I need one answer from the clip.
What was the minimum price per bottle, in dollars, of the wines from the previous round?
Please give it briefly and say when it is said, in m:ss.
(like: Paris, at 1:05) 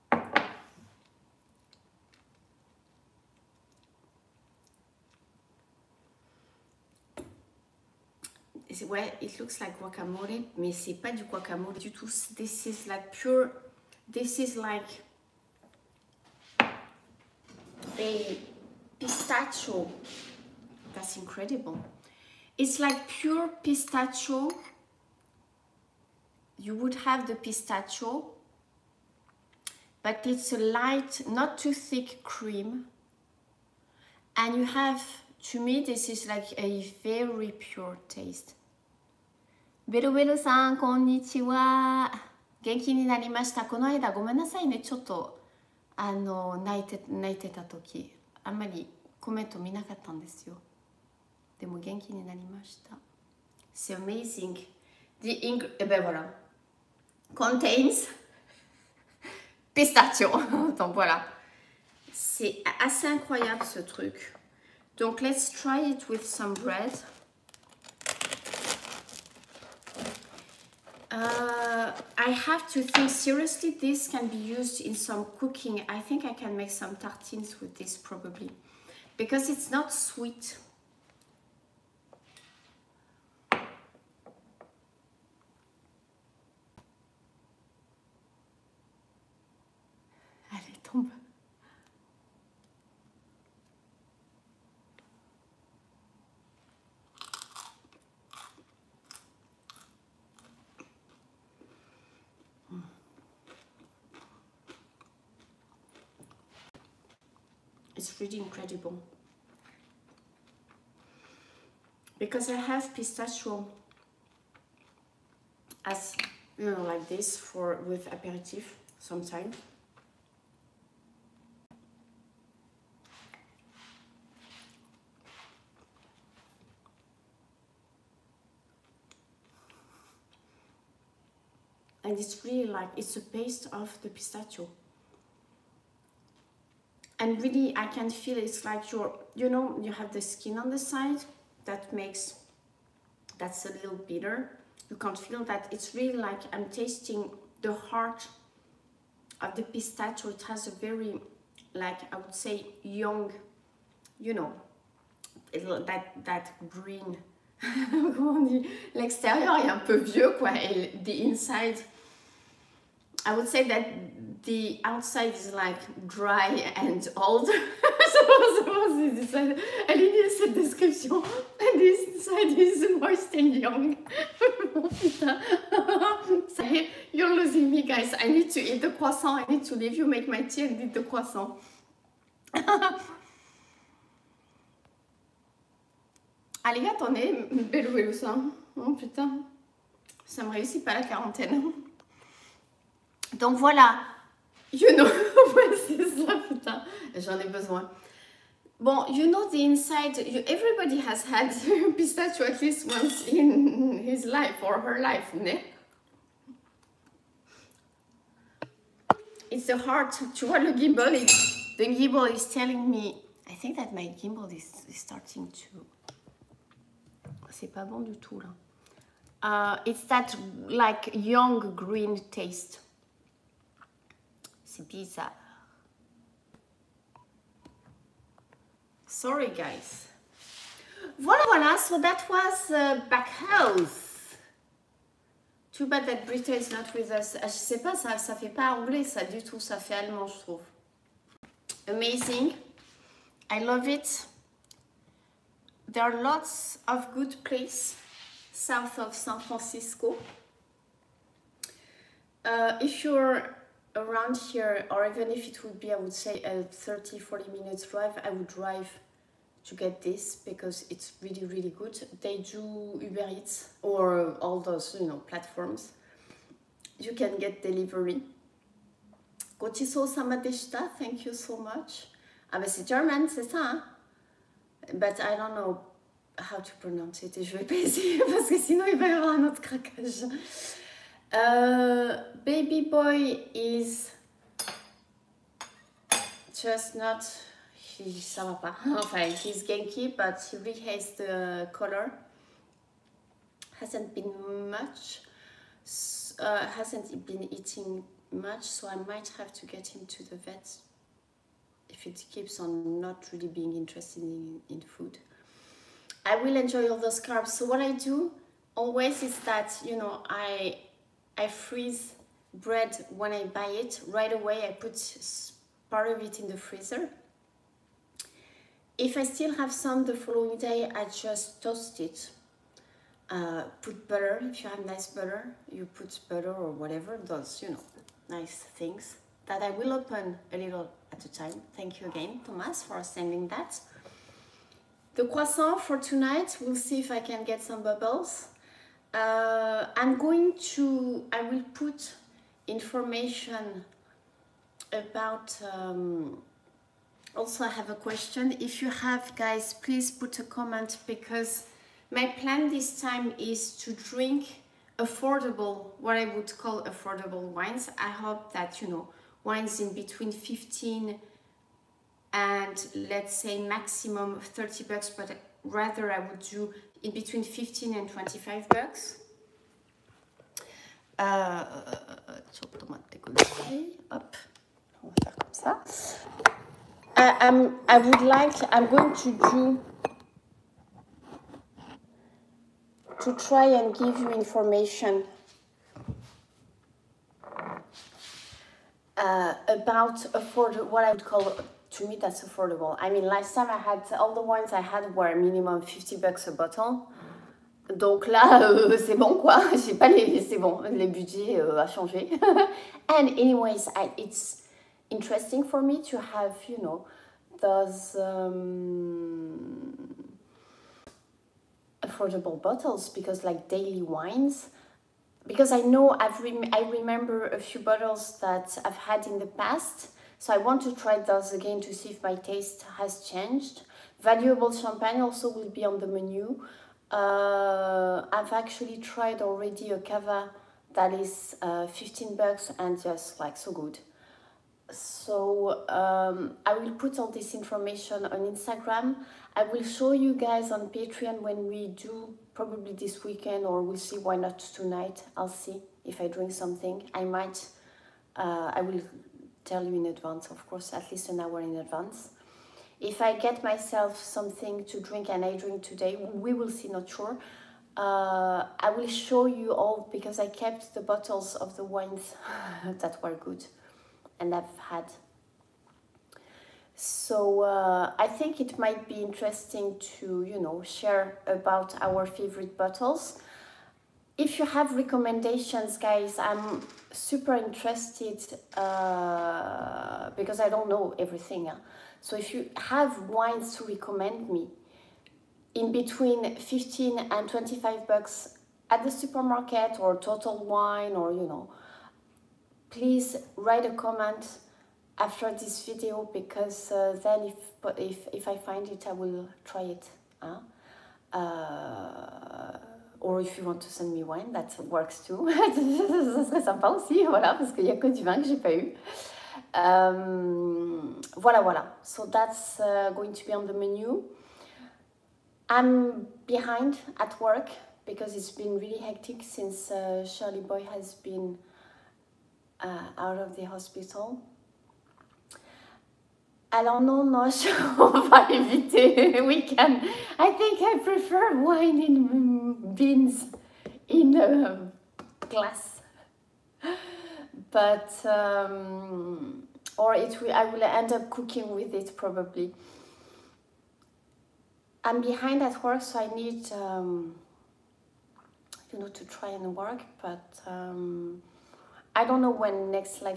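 50, at 6:35.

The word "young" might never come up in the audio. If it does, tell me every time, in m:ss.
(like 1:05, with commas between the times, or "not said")
2:32, 2:53, 3:41.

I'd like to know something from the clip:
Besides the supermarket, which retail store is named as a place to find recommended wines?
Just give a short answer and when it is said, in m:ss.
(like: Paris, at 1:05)
Total Wine, at 8:10.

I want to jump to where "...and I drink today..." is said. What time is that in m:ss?
7:35.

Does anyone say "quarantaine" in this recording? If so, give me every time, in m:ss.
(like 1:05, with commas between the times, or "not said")
3:11.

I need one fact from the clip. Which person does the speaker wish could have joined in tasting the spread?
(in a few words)
Britta.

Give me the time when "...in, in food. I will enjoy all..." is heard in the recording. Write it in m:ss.
5:04.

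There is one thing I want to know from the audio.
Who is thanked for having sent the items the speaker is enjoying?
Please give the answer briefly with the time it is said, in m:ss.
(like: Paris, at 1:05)
Thomas, at 5:32.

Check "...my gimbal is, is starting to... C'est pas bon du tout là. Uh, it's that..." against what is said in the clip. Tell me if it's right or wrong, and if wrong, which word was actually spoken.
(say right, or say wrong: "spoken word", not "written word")
right.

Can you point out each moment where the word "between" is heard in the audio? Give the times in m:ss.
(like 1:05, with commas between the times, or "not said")
5:59, 6:07, 8:05.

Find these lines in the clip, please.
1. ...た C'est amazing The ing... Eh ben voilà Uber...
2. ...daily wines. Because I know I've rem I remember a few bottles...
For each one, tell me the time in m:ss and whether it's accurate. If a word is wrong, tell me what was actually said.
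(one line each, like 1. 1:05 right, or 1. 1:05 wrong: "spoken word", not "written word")
1. 0:52 wrong: "Contains", not "Uber"
2. 6:53 right.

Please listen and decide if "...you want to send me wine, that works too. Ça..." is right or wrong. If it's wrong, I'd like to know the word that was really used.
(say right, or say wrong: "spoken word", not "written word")
right.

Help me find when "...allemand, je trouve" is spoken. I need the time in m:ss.
3:59.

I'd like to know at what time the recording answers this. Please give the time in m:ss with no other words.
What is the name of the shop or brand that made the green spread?
3:53.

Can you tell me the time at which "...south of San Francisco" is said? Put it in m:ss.
4:08.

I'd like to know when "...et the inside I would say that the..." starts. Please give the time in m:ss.
2:40.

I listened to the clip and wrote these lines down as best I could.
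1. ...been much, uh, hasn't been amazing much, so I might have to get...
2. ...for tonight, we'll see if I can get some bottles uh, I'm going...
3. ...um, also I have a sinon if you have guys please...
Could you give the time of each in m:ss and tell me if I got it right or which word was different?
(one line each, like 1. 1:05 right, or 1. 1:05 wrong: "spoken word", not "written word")
1. 4:54 wrong: "eating", not "amazing"
2. 5:35 wrong: "bubbles", not "bottles"
3. 5:45 wrong: "question", not "sinon".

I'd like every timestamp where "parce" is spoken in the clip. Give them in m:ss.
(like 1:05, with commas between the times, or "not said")
4:38, 8:27.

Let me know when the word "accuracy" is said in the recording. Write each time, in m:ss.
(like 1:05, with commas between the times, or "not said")
not said.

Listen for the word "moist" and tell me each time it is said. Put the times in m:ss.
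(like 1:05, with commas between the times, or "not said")
2:52.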